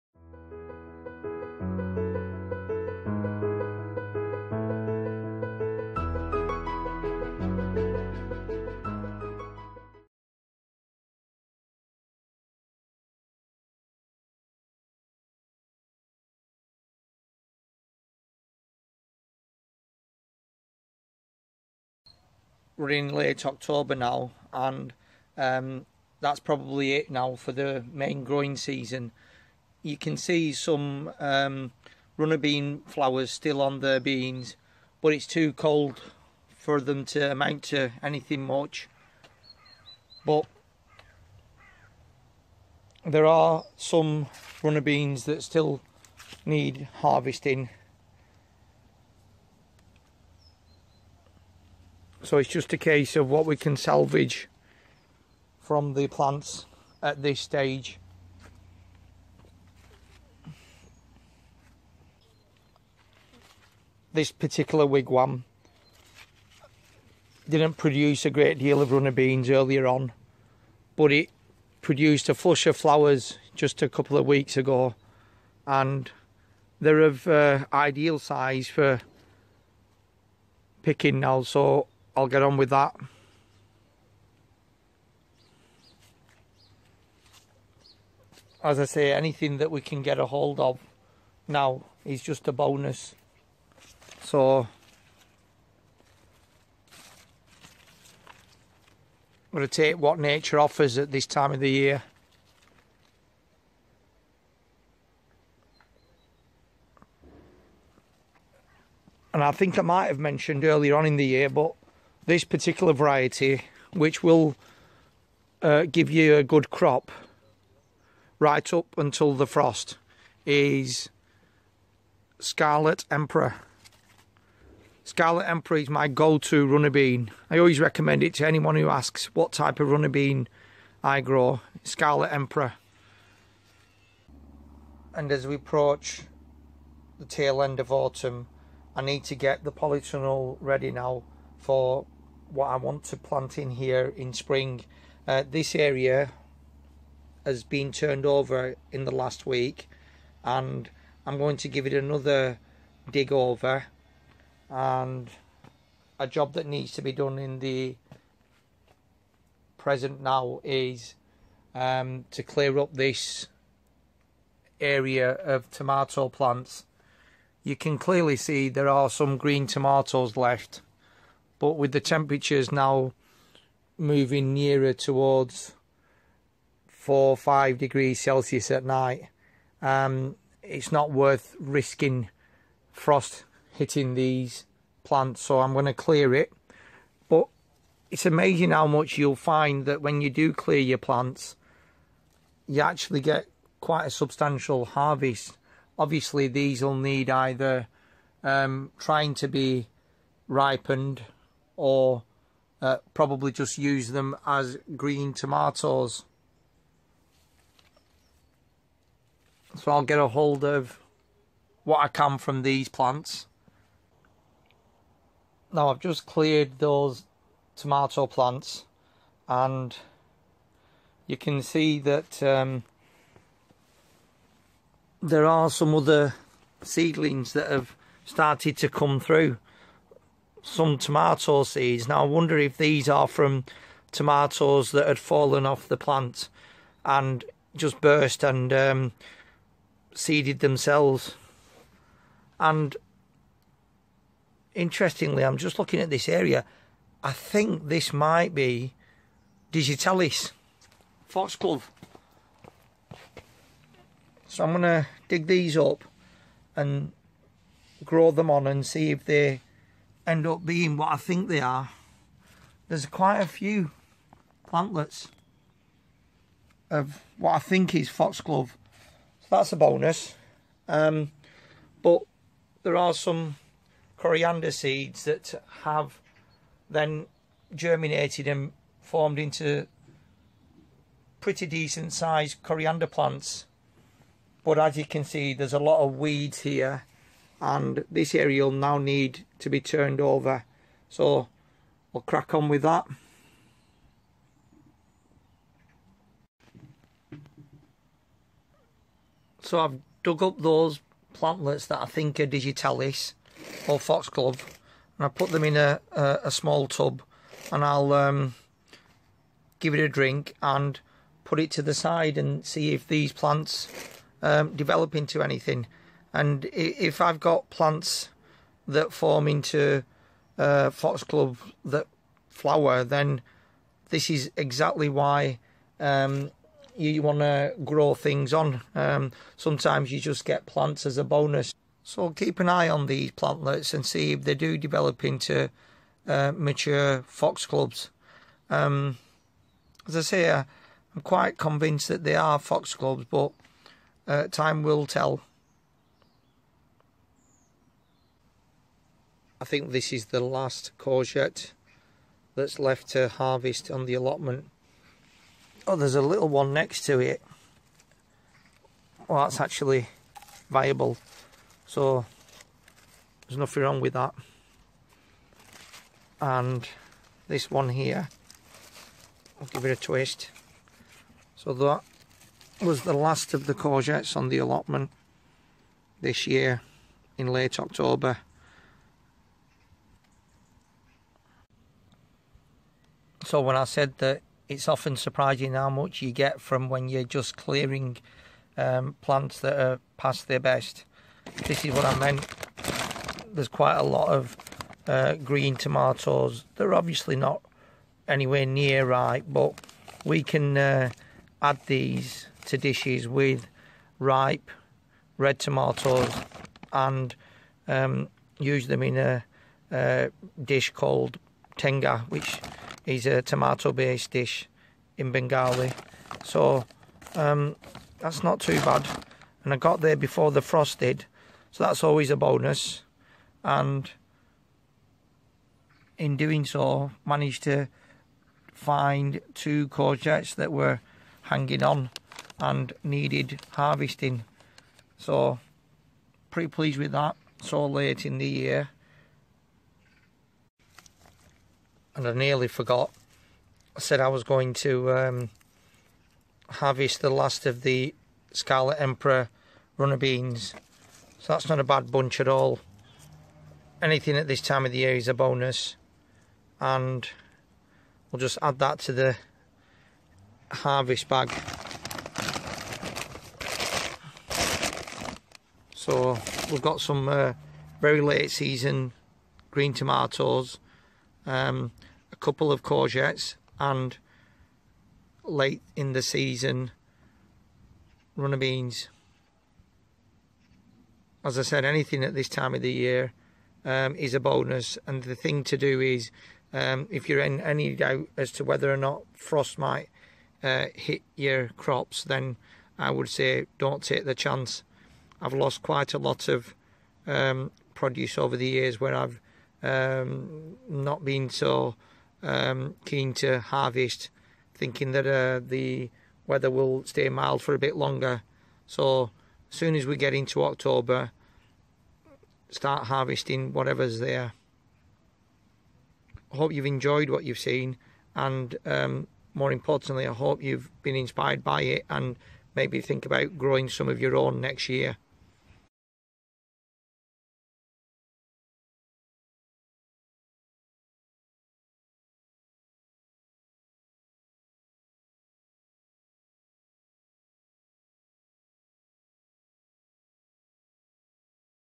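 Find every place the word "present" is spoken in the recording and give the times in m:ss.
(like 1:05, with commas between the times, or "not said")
2:39.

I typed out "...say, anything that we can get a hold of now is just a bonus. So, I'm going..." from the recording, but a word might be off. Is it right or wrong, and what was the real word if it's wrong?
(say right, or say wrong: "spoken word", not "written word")
right.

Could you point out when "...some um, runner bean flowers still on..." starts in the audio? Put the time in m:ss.
0:30.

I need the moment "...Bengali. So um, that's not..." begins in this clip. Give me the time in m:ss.
6:55.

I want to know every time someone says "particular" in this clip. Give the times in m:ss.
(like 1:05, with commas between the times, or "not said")
1:04, 1:52.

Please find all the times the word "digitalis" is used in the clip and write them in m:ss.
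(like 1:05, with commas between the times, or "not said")
4:09, 5:02.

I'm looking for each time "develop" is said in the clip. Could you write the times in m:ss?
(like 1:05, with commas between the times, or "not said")
5:14, 5:34.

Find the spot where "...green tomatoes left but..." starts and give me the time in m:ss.
2:49.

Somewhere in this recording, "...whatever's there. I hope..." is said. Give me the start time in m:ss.
8:33.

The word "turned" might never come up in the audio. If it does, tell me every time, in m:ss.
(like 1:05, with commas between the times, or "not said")
2:27, 4:49.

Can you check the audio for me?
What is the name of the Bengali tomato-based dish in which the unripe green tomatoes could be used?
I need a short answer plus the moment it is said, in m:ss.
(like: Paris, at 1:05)
Tenga, at 6:51.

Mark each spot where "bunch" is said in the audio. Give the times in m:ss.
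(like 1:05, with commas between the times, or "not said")
7:32.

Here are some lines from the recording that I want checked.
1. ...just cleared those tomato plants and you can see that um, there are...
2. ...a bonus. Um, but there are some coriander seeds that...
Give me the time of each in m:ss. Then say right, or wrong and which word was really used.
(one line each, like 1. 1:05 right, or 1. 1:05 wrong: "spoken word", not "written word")
1. 3:35 right
2. 4:29 right.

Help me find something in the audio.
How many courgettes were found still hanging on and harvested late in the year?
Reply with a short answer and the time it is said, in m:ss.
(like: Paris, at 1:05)
2, at 7:09.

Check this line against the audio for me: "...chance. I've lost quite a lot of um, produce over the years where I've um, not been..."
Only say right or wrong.
right.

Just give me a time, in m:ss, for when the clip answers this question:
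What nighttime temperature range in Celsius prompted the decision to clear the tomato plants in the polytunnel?
2:56.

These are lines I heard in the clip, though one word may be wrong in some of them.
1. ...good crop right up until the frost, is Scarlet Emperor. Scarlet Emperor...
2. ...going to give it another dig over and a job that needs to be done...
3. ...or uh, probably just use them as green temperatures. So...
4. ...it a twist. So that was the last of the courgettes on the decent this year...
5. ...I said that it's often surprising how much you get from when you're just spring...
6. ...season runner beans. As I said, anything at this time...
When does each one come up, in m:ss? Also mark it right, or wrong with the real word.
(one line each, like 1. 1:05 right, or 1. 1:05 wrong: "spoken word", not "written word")
1. 1:56 right
2. 2:31 right
3. 3:21 wrong: "tomatoes", not "temperatures"
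4. 6:09 wrong: "allotment", not "decent"
5. 6:23 wrong: "clearing", not "spring"
6. 7:56 right.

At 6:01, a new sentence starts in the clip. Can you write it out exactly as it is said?
So there's nothing wrong with that.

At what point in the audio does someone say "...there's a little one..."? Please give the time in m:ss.
5:55.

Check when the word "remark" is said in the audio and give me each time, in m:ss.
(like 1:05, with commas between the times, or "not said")
not said.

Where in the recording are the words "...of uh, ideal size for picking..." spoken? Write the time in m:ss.
1:17.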